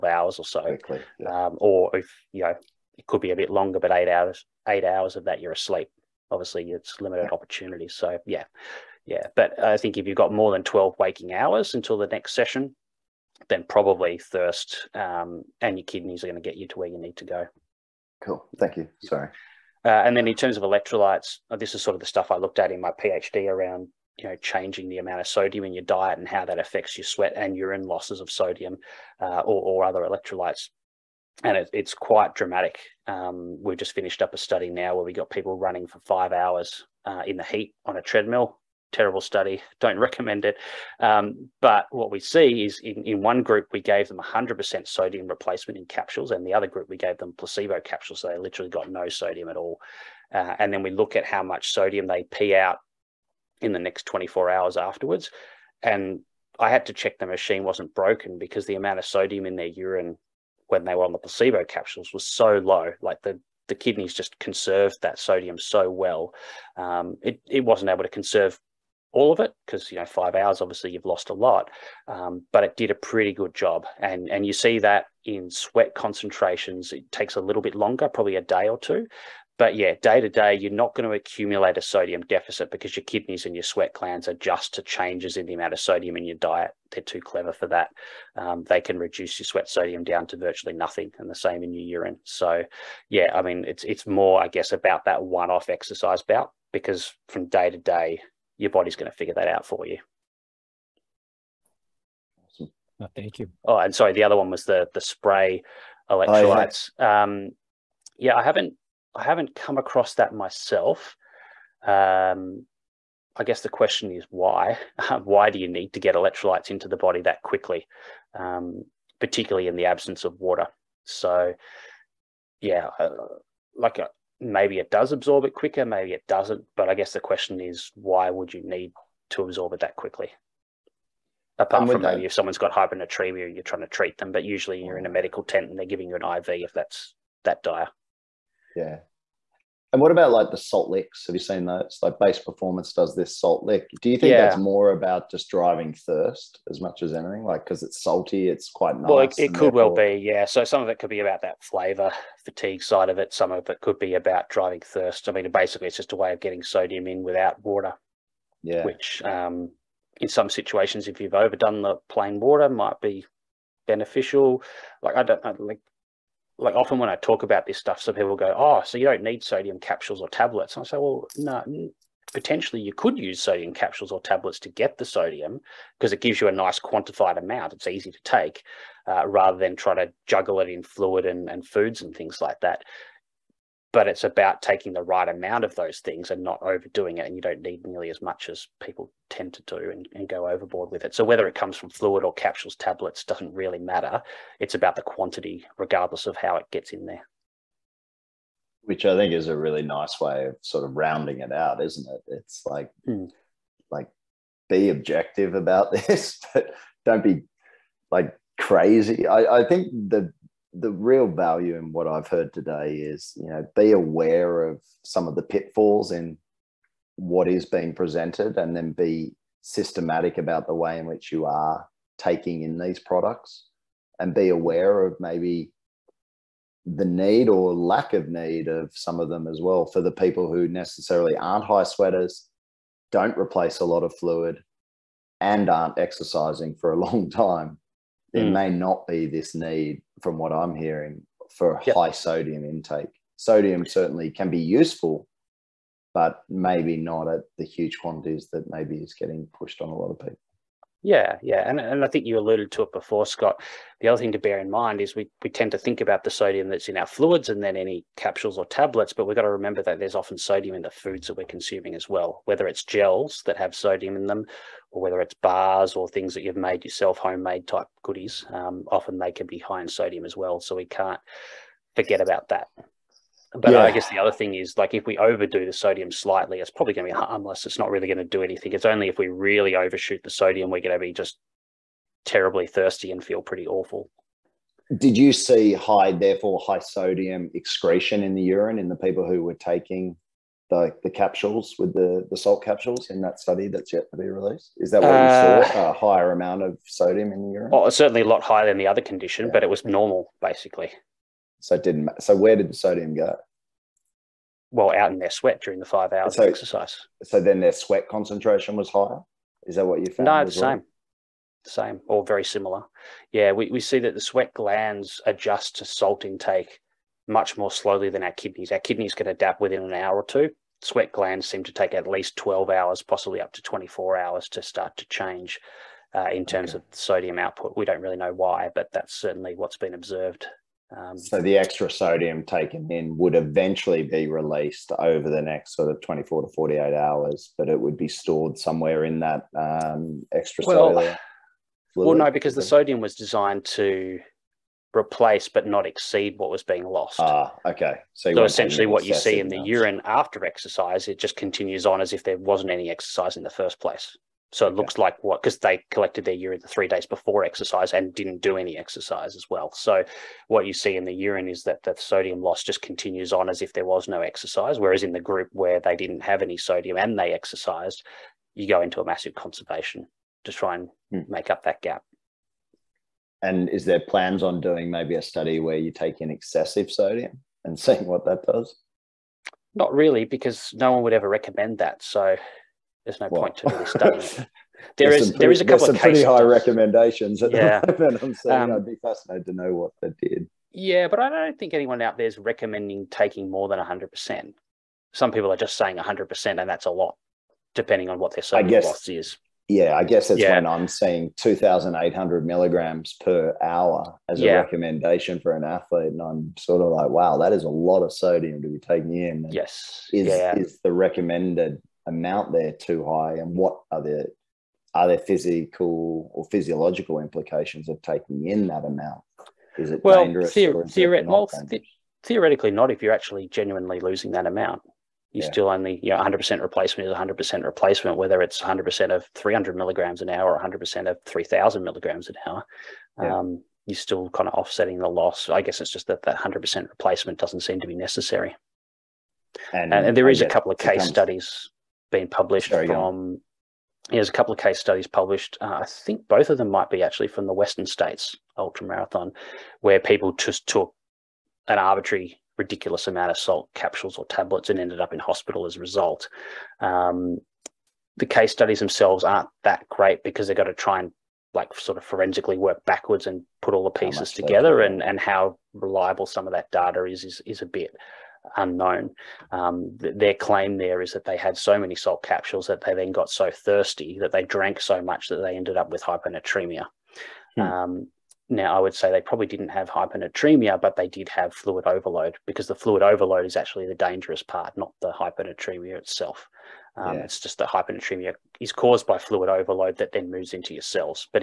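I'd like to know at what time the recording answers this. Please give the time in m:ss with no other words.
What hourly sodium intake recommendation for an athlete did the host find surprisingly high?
6:41.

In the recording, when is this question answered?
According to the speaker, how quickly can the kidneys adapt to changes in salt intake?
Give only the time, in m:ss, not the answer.
5:19.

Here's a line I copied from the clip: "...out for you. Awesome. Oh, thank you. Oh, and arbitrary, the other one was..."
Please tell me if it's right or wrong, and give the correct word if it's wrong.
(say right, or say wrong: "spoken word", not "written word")
wrong: "sorry", not "arbitrary".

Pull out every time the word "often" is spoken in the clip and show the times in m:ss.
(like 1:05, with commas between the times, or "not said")
2:46, 4:20, 4:28.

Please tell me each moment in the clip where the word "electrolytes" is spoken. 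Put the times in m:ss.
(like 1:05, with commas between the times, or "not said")
0:20, 0:29, 1:46, 1:56.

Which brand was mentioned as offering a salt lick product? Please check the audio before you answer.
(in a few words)
Base Performance.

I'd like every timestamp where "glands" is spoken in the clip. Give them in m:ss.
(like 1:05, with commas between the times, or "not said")
1:23, 5:14, 5:21.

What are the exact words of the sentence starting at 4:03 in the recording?
Sodium certainly can be useful, but maybe not at the huge quantities that maybe is getting pushed on a lot of people.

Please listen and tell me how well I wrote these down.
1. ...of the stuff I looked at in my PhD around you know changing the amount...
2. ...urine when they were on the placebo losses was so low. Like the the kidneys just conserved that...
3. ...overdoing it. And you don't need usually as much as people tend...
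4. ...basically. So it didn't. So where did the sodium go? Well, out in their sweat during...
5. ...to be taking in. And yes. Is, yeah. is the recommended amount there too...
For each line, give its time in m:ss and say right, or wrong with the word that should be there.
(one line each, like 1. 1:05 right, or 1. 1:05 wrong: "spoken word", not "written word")
1. 0:21 right
2. 0:59 wrong: "capsules", not "losses"
3. 3:06 wrong: "nearly", not "usually"
4. 5:00 right
5. 6:48 right.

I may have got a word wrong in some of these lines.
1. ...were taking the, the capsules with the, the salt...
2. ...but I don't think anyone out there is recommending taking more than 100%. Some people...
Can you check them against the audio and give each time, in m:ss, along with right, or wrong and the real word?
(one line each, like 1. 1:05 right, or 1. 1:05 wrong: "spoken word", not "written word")
1. 4:49 right
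2. 6:31 right.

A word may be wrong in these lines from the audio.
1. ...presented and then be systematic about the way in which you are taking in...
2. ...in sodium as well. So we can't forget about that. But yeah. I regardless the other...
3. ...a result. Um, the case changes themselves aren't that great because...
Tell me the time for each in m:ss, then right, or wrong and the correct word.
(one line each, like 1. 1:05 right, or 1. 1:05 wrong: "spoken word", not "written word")
1. 3:37 right
2. 4:29 wrong: "guess", not "regardless"
3. 7:35 wrong: "studies", not "changes".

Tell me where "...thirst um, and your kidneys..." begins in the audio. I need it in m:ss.
0:14.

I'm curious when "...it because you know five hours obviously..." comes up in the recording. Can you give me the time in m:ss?
1:09.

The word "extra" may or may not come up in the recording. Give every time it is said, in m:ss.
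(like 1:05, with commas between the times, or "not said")
5:31, 5:40.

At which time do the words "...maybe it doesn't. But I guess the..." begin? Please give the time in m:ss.
2:05.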